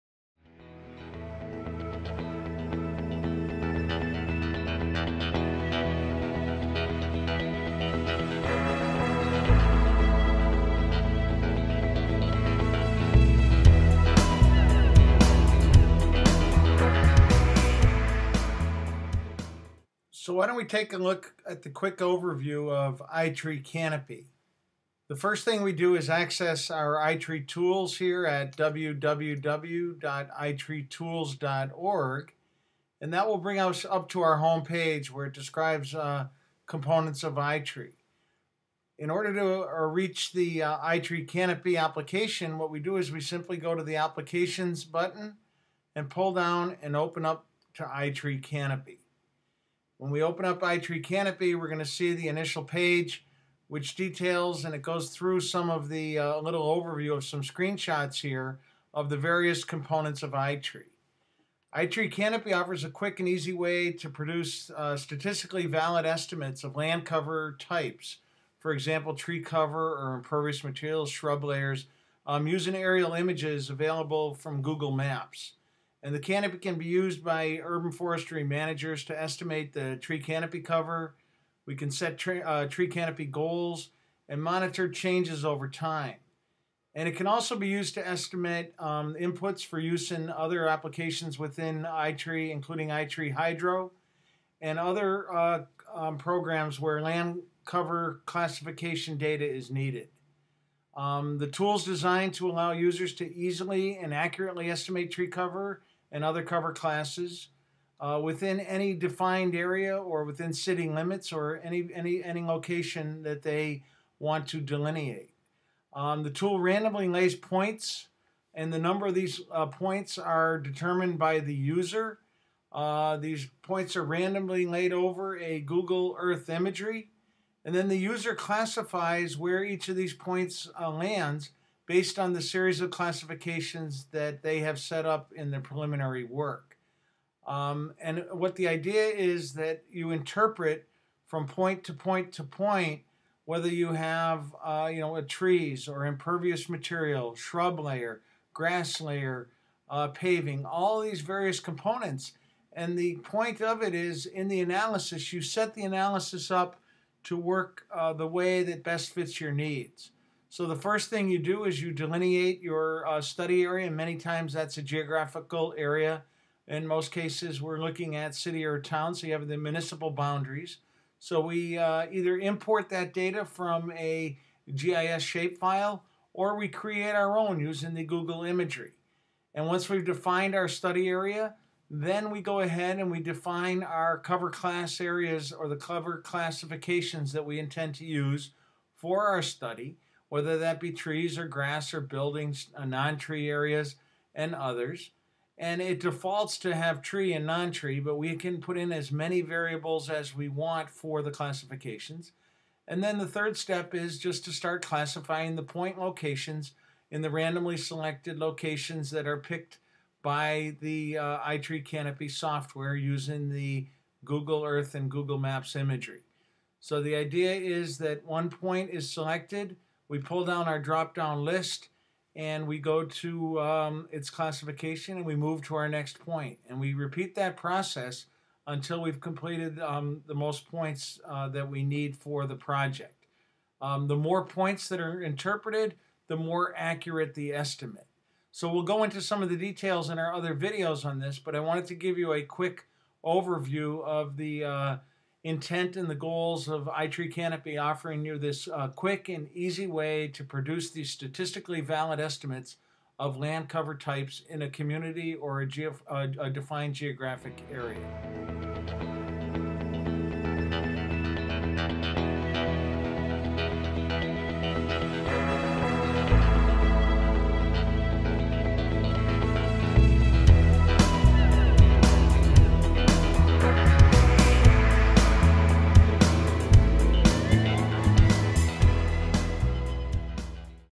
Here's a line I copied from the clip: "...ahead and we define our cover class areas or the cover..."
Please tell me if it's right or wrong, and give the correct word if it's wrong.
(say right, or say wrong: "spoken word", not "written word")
right.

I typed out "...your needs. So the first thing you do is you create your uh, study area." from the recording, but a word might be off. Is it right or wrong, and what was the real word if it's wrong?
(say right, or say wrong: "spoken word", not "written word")
wrong: "delineate", not "create".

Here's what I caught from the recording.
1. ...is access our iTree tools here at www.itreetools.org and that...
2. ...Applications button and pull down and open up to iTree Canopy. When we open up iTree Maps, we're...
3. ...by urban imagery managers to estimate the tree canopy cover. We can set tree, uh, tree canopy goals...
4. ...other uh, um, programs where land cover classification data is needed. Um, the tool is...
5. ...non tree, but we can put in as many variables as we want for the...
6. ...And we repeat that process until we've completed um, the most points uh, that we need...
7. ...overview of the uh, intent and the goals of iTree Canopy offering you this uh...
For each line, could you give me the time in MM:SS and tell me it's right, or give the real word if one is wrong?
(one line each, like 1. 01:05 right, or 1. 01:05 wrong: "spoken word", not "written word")
1. 00:25 right
2. 00:43 wrong: "Canopy", not "Maps"
3. 01:17 wrong: "forestry", not "imagery"
4. 01:34 right
5. 03:17 right
6. 03:46 right
7. 04:03 right.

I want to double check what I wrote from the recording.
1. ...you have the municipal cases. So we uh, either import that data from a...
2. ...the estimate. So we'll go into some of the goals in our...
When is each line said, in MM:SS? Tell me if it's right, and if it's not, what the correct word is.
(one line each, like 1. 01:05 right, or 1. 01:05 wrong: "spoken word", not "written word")
1. 02:49 wrong: "boundaries", not "cases"
2. 03:57 wrong: "details", not "goals".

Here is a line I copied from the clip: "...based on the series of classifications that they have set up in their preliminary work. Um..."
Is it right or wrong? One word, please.
right.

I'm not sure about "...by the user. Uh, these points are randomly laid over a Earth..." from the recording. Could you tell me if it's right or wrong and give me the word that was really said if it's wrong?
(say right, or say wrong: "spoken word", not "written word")
wrong: "Google", not "Earth".